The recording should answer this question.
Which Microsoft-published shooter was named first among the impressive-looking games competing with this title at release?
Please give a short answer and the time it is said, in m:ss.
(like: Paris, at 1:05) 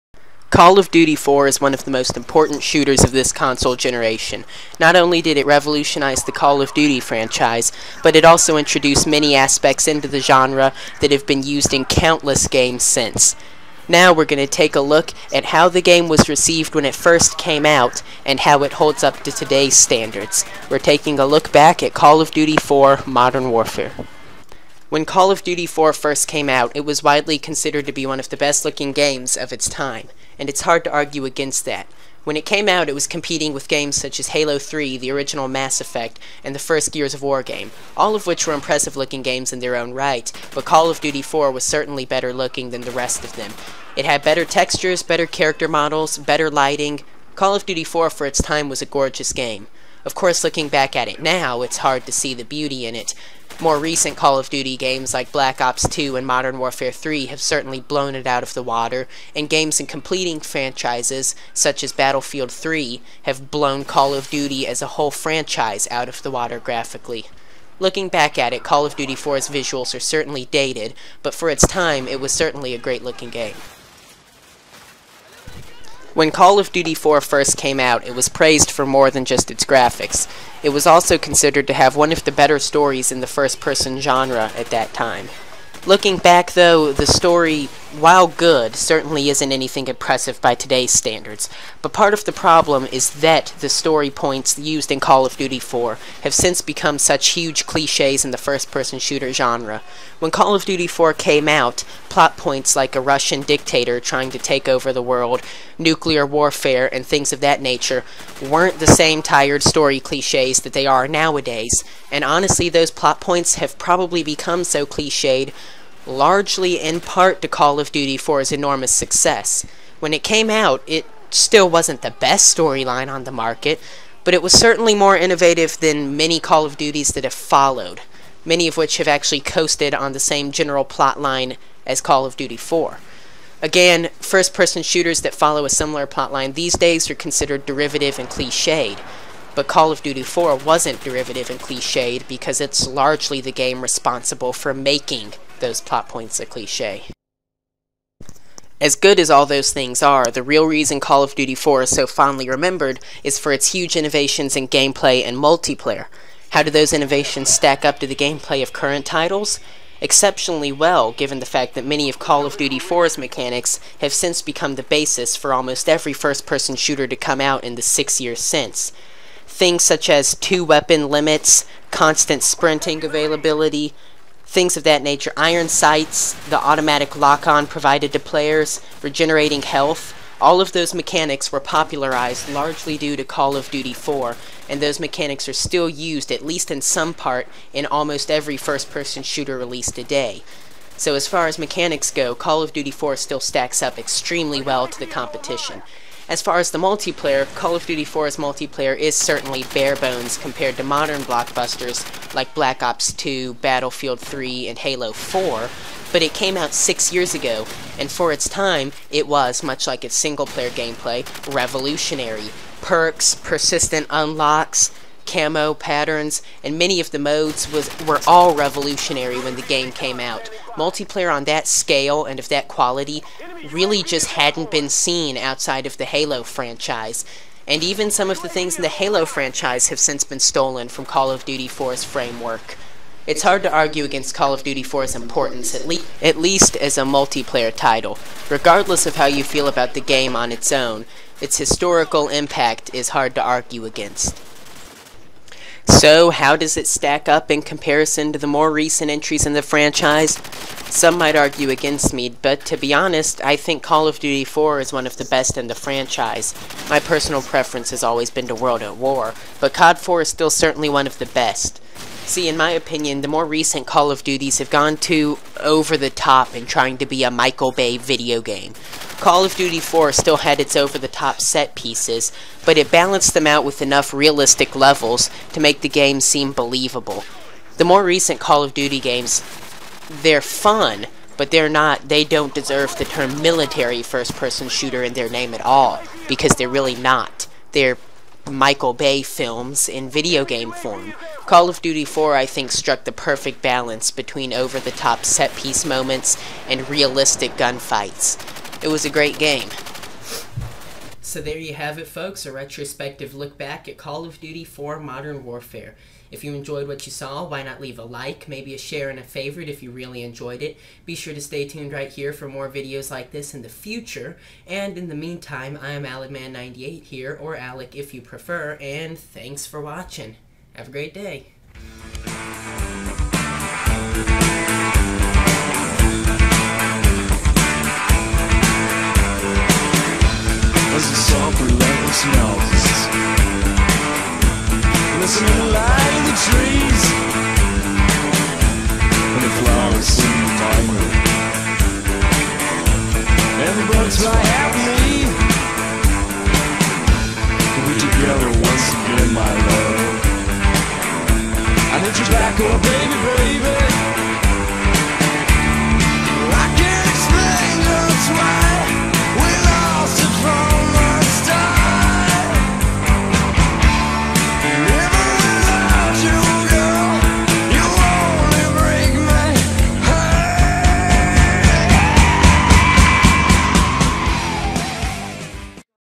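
Halo 3, at 0:34.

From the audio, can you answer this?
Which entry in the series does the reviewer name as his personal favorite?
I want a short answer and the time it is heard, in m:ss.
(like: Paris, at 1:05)
World at War, at 4:18.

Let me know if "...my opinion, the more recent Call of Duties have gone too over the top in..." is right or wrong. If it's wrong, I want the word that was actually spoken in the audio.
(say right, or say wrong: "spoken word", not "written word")
right.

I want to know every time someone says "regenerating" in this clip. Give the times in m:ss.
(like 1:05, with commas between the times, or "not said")
2:59.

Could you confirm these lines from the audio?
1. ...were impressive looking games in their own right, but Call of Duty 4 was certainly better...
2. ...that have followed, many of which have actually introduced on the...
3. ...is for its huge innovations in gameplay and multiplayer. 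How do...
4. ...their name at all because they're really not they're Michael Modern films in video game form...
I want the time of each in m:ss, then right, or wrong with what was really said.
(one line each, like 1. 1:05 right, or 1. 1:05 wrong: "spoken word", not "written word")
1. 0:38 right
2. 2:07 wrong: "coasted", not "introduced"
3. 2:33 right
4. 4:45 wrong: "Bay", not "Modern".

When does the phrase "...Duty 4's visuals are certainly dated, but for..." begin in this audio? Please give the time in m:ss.
1:08.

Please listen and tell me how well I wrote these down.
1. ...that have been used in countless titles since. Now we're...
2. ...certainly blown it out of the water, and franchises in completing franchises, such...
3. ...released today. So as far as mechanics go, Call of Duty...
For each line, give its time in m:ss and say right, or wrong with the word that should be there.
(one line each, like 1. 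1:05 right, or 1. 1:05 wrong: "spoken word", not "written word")
1. 0:10 wrong: "games", not "titles"
2. 0:57 wrong: "games", not "franchises"
3. 3:09 right.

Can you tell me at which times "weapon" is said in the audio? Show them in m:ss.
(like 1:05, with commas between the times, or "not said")
2:50.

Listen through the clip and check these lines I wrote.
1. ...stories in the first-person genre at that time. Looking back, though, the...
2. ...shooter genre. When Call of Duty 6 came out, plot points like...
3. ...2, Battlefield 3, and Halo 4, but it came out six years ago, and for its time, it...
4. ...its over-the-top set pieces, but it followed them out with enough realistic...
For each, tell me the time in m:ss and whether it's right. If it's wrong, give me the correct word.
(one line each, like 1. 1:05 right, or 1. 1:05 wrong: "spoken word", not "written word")
1. 1:22 right
2. 1:38 wrong: "4", not "6"
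3. 3:23 right
4. 4:30 wrong: "balanced", not "followed".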